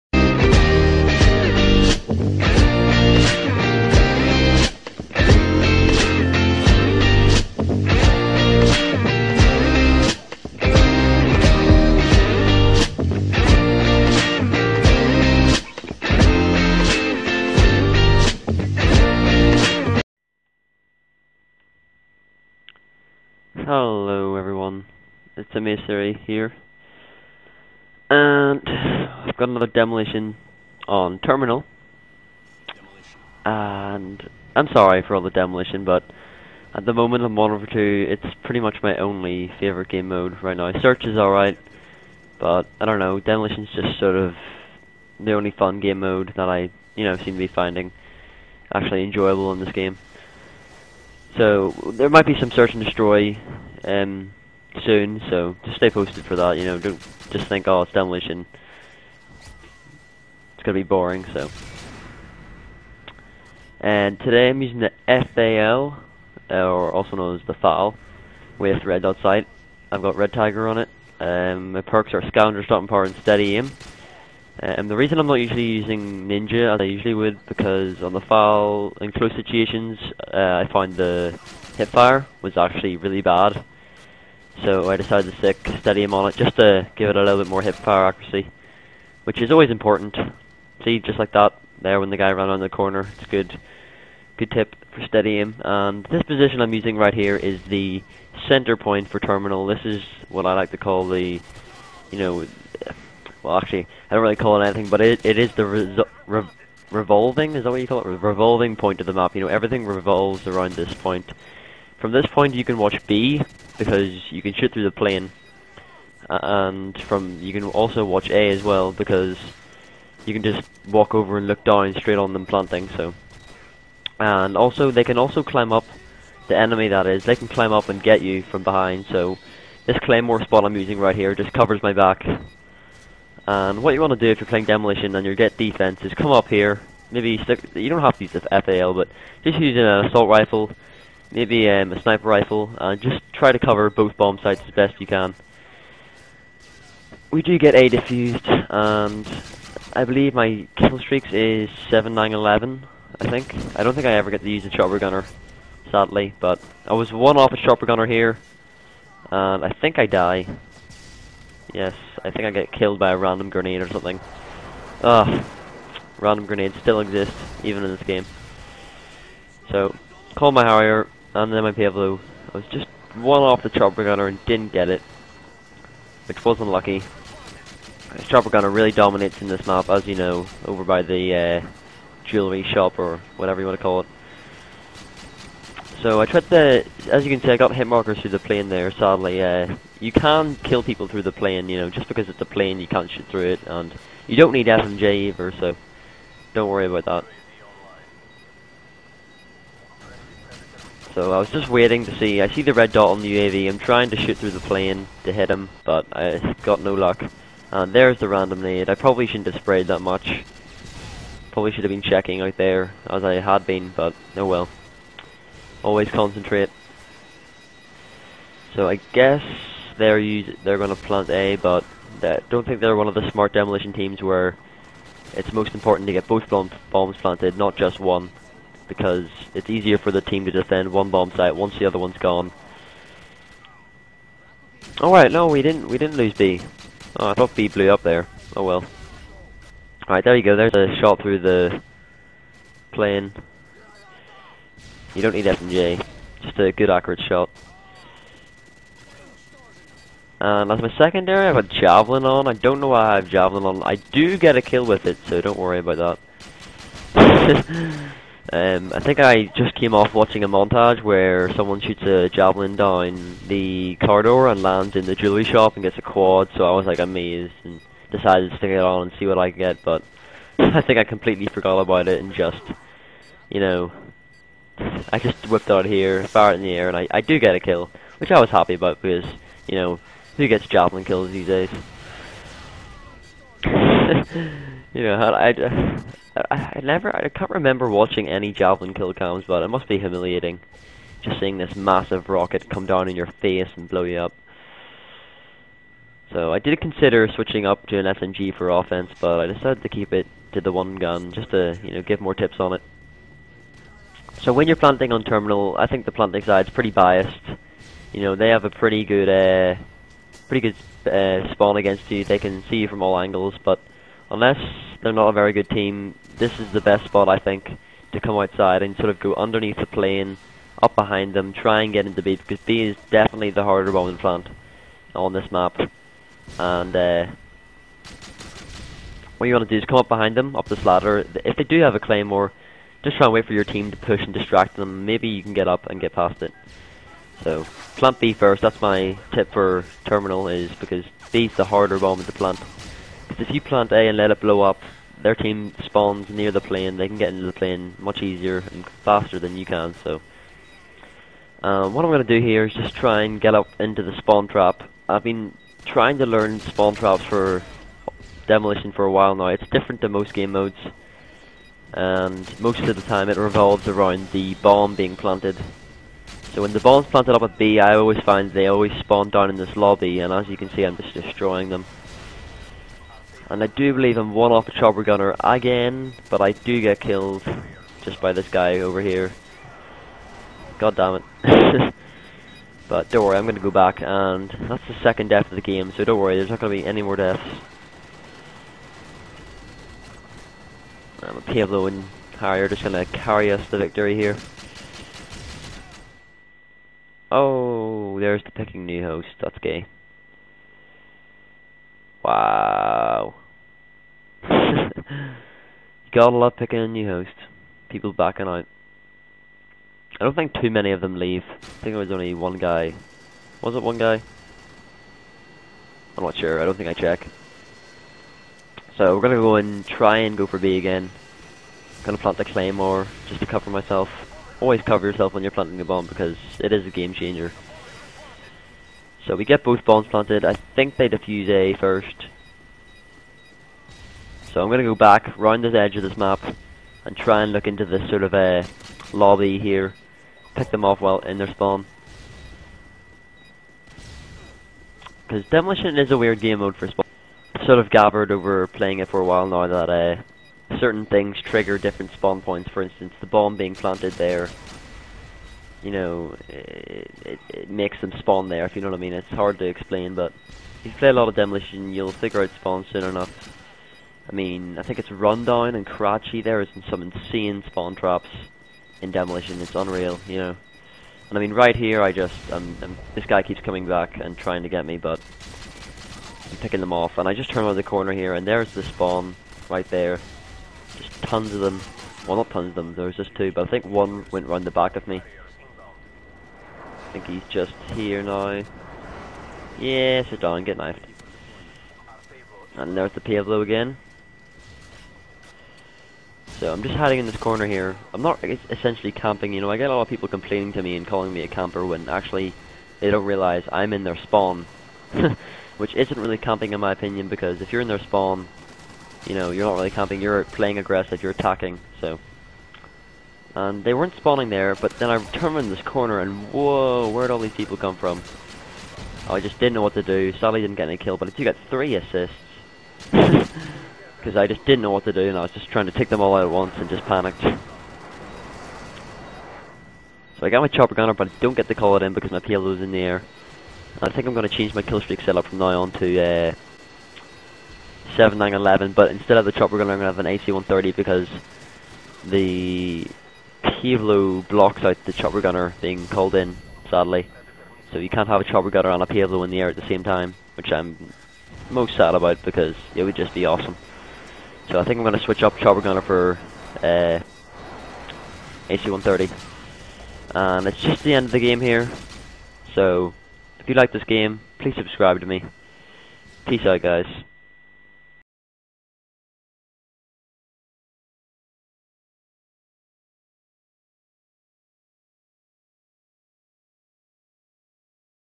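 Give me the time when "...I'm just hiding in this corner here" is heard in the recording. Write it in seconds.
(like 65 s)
496 s.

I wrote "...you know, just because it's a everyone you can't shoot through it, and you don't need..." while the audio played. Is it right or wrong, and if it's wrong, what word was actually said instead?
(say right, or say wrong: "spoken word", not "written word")
wrong: "plane", not "everyone".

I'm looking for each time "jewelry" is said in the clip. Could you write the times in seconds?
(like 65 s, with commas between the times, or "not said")
182 s, 265 s.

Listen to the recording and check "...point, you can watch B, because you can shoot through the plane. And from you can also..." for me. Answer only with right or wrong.
right.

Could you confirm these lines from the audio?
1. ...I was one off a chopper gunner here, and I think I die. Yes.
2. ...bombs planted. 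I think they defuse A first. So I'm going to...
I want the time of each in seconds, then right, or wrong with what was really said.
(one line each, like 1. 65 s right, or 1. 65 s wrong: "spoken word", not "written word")
1. 156 s right
2. 429 s right.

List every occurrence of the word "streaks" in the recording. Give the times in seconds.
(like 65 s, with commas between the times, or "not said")
150 s, 535 s.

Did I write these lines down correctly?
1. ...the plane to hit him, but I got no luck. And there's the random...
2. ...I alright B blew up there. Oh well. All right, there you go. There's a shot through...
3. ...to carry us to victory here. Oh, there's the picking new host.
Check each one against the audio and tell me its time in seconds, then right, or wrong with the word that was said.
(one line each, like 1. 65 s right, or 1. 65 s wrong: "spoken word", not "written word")
1. 204 s right
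2. 237 s wrong: "thought", not "alright"
3. 392 s right.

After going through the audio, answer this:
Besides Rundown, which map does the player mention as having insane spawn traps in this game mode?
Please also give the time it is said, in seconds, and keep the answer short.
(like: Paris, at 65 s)
Karachi, at 465 s.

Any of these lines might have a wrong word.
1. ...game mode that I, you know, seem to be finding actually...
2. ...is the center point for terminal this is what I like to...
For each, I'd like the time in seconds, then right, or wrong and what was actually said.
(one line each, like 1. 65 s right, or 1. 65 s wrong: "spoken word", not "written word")
1. 45 s right
2. 97 s right.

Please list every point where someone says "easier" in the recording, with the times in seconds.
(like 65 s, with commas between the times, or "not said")
229 s, 348 s.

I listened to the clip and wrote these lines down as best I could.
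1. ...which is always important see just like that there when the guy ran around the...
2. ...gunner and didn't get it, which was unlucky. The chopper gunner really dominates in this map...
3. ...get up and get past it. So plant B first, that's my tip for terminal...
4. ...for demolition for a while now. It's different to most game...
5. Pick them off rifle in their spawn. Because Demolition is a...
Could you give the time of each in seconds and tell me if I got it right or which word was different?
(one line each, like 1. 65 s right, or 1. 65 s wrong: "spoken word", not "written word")
1. 89 s right
2. 174 s right
3. 335 s right
4. 357 s right
5. 440 s wrong: "while", not "rifle".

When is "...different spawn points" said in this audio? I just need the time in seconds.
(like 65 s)
451 s.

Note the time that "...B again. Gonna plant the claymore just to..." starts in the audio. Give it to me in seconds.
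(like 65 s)
420 s.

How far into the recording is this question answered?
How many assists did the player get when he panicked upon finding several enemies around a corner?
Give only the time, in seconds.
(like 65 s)
521 s.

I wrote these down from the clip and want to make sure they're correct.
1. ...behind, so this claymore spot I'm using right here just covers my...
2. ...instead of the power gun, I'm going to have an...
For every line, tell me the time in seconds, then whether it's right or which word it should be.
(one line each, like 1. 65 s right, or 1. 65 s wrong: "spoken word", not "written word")
1. 128 s right
2. 539 s wrong: "chopper", not "power".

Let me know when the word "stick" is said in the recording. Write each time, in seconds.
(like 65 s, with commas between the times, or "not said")
85 s, 137 s, 268 s.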